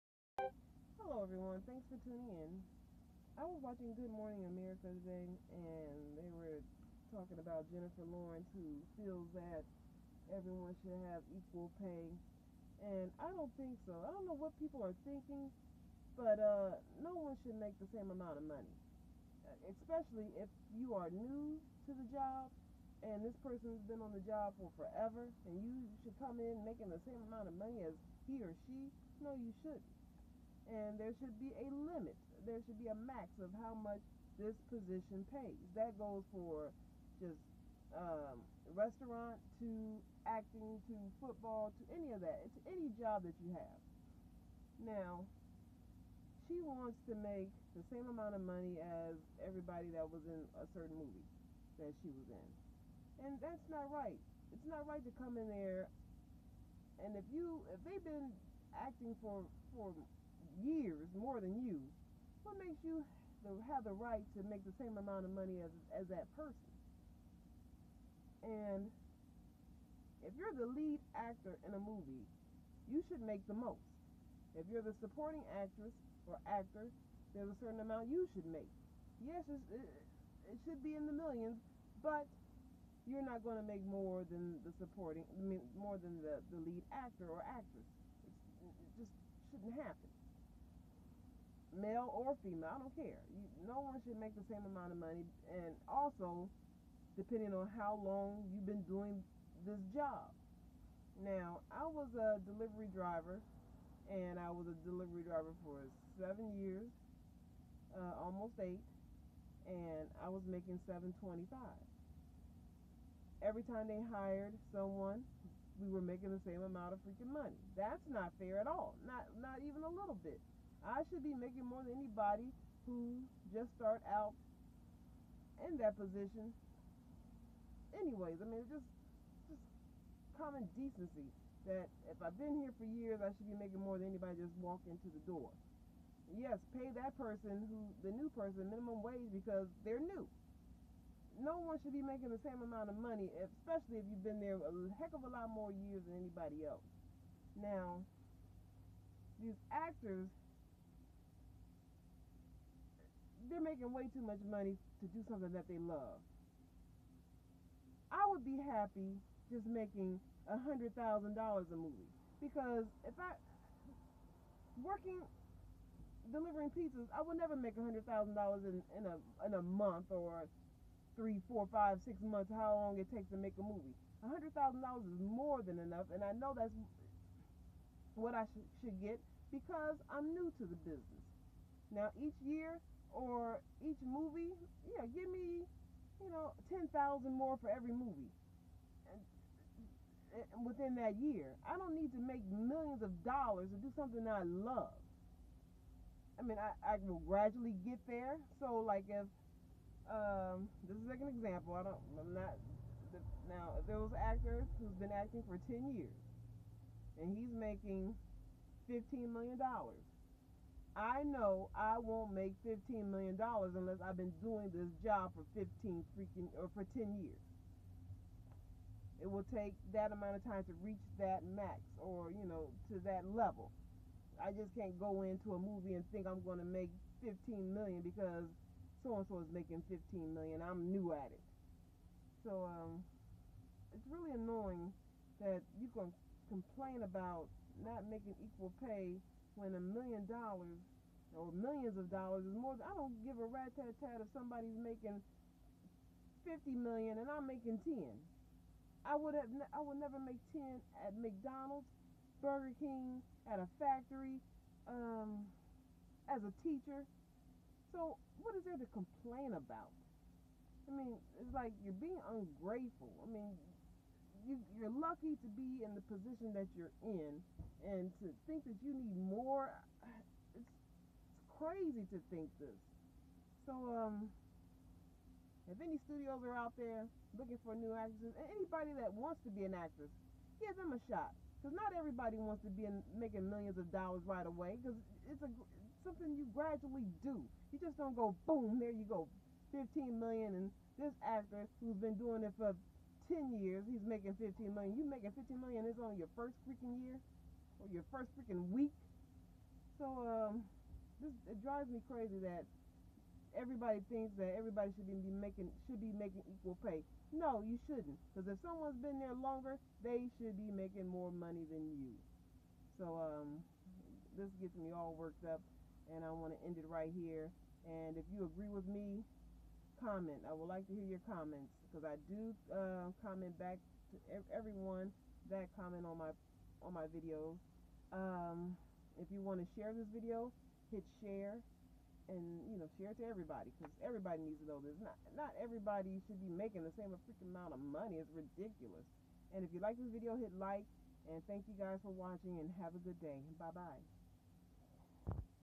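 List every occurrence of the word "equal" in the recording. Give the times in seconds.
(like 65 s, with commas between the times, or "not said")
11 s, 238 s, 306 s.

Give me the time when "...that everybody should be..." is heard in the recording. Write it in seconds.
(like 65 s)
304 s.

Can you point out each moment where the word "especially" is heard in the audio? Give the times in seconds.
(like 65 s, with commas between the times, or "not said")
19 s, 143 s.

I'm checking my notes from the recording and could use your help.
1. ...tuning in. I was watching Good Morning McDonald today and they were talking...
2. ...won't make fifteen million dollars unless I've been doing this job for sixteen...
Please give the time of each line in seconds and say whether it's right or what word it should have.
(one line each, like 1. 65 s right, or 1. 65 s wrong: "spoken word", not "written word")
1. 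2 s wrong: "America", not "McDonald"
2. 211 s wrong: "fifteen", not "sixteen".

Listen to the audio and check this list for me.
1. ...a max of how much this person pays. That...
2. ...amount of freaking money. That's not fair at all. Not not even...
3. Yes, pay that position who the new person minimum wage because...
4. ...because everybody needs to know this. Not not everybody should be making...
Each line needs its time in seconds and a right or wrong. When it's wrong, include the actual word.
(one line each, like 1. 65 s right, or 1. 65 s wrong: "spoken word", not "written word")
1. 32 s wrong: "position", not "person"
2. 116 s right
3. 136 s wrong: "person", not "position"
4. 333 s right.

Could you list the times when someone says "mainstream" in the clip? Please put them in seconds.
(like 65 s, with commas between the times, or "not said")
not said.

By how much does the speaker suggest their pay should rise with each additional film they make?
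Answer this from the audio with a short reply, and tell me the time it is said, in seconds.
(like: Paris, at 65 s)
10,000, at 186 s.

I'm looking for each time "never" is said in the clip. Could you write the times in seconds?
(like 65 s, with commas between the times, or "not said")
167 s, 249 s.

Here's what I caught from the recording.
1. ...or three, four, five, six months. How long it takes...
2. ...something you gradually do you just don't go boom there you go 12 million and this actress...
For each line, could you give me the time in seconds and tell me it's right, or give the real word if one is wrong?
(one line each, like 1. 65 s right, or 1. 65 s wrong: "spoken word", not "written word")
1. 170 s right
2. 286 s wrong: "15", not "12".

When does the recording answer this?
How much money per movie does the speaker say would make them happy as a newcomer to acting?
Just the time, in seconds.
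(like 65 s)
160 s.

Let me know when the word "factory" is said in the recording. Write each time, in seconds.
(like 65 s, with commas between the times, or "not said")
253 s.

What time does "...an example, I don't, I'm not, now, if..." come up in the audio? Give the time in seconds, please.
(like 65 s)
201 s.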